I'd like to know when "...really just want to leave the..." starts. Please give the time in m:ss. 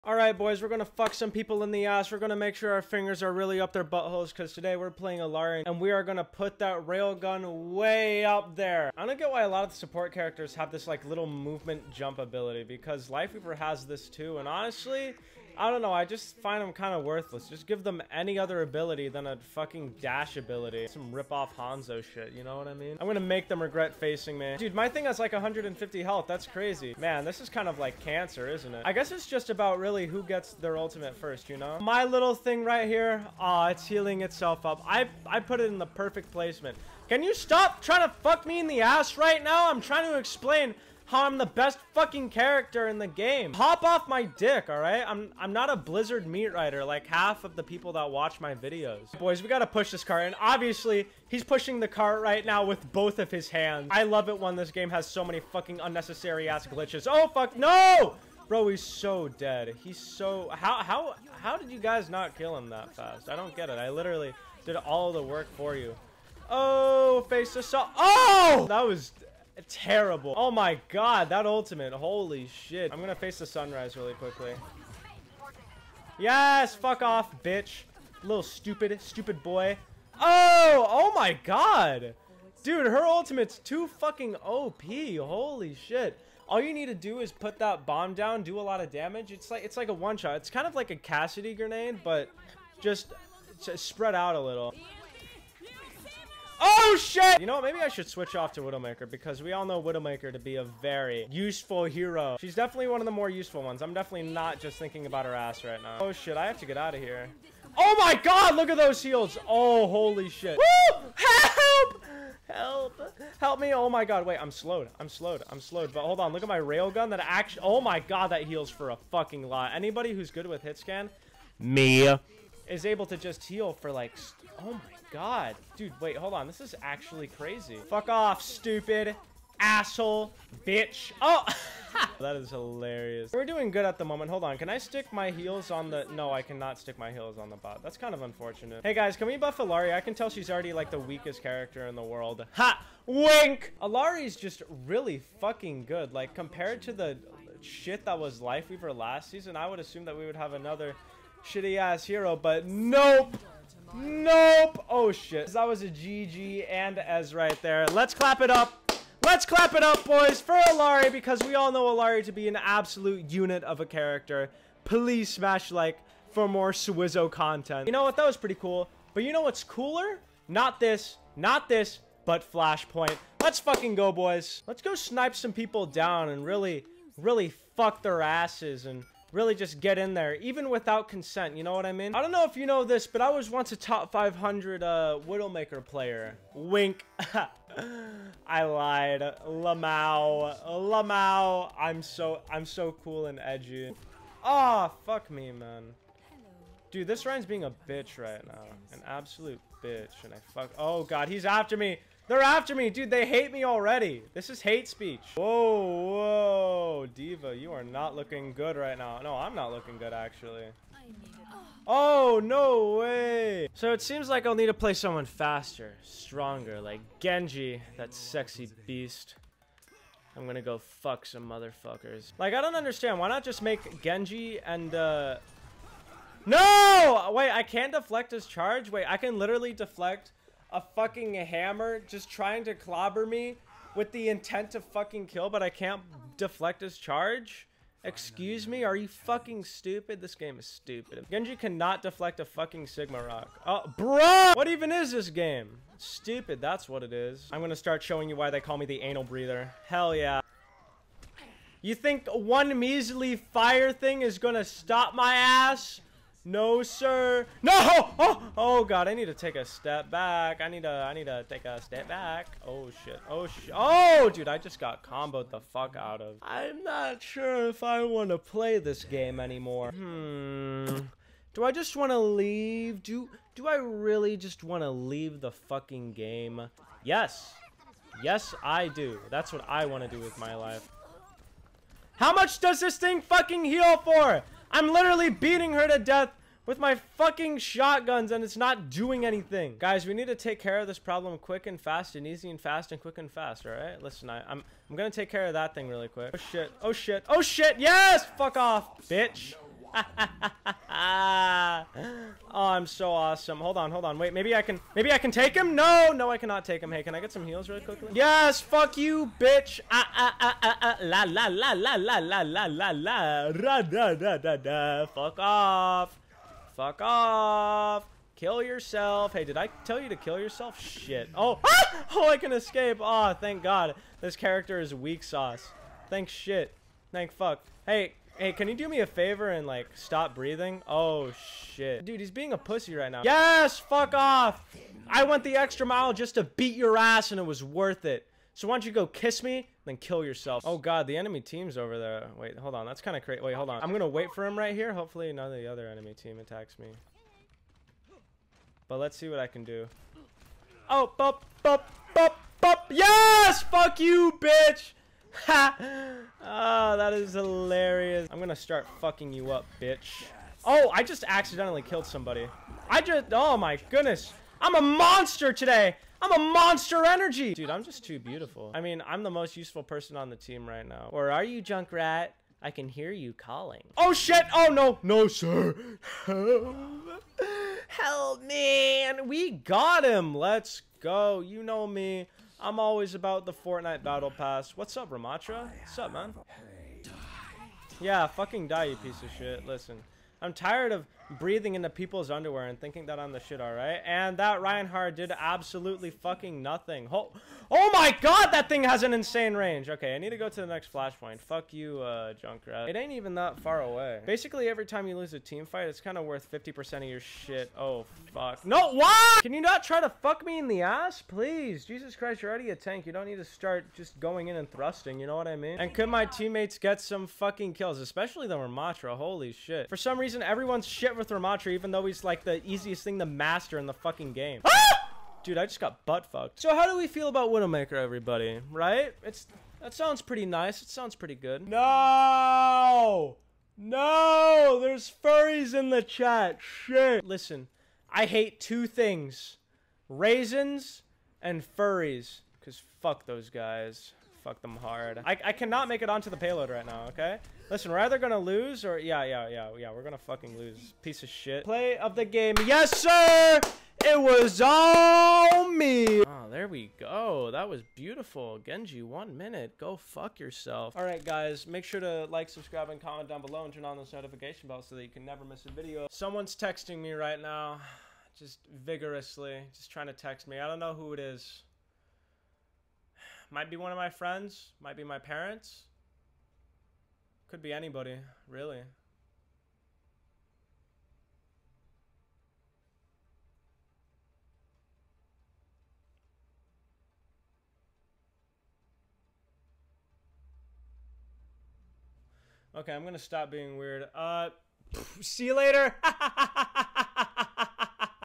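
4:33.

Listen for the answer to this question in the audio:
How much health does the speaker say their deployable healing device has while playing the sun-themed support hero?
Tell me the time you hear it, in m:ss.
0:25.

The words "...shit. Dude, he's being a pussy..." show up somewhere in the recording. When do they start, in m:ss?
5:31.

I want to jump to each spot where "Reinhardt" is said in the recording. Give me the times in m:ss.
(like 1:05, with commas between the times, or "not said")
6:34.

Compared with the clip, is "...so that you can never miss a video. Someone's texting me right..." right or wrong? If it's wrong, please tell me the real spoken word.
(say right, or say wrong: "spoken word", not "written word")
right.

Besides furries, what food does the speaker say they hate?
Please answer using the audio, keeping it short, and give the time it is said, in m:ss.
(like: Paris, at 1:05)
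Raisins, at 7:20.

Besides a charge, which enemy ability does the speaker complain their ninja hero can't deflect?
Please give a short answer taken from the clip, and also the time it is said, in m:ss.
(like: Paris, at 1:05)
Sigma Rock, at 4:02.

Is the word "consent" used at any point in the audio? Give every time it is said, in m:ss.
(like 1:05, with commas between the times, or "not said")
3:01.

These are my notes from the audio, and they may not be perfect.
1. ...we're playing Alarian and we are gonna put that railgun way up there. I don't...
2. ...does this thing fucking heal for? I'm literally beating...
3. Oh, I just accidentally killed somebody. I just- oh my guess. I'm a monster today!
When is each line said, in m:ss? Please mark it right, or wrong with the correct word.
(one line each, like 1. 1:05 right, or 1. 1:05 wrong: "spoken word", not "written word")
1. 0:04 right
2. 4:42 right
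3. 6:00 wrong: "goodness", not "guess".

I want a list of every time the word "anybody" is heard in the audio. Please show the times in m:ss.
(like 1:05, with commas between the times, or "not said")
1:59, 7:57.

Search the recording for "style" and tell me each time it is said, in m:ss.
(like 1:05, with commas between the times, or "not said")
not said.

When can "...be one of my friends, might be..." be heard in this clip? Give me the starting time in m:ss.
7:53.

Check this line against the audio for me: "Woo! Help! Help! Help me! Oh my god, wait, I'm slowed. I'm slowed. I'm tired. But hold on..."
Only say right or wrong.
wrong.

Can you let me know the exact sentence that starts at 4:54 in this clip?
Listen, I, am I'm, I'm gonna take care of that thing really quick.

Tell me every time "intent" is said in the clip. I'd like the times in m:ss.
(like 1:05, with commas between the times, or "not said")
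3:54.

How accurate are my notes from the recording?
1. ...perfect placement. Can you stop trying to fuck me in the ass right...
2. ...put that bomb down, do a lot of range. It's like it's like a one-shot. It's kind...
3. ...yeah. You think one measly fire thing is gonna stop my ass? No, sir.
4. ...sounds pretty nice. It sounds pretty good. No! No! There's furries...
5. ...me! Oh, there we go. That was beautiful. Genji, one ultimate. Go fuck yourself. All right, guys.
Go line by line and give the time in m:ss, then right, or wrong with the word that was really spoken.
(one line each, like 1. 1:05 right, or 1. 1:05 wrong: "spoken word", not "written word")
1. 0:35 right
2. 1:27 wrong: "damage", not "range"
3. 4:10 right
4. 7:09 right
5. 7:35 wrong: "minute", not "ultimate".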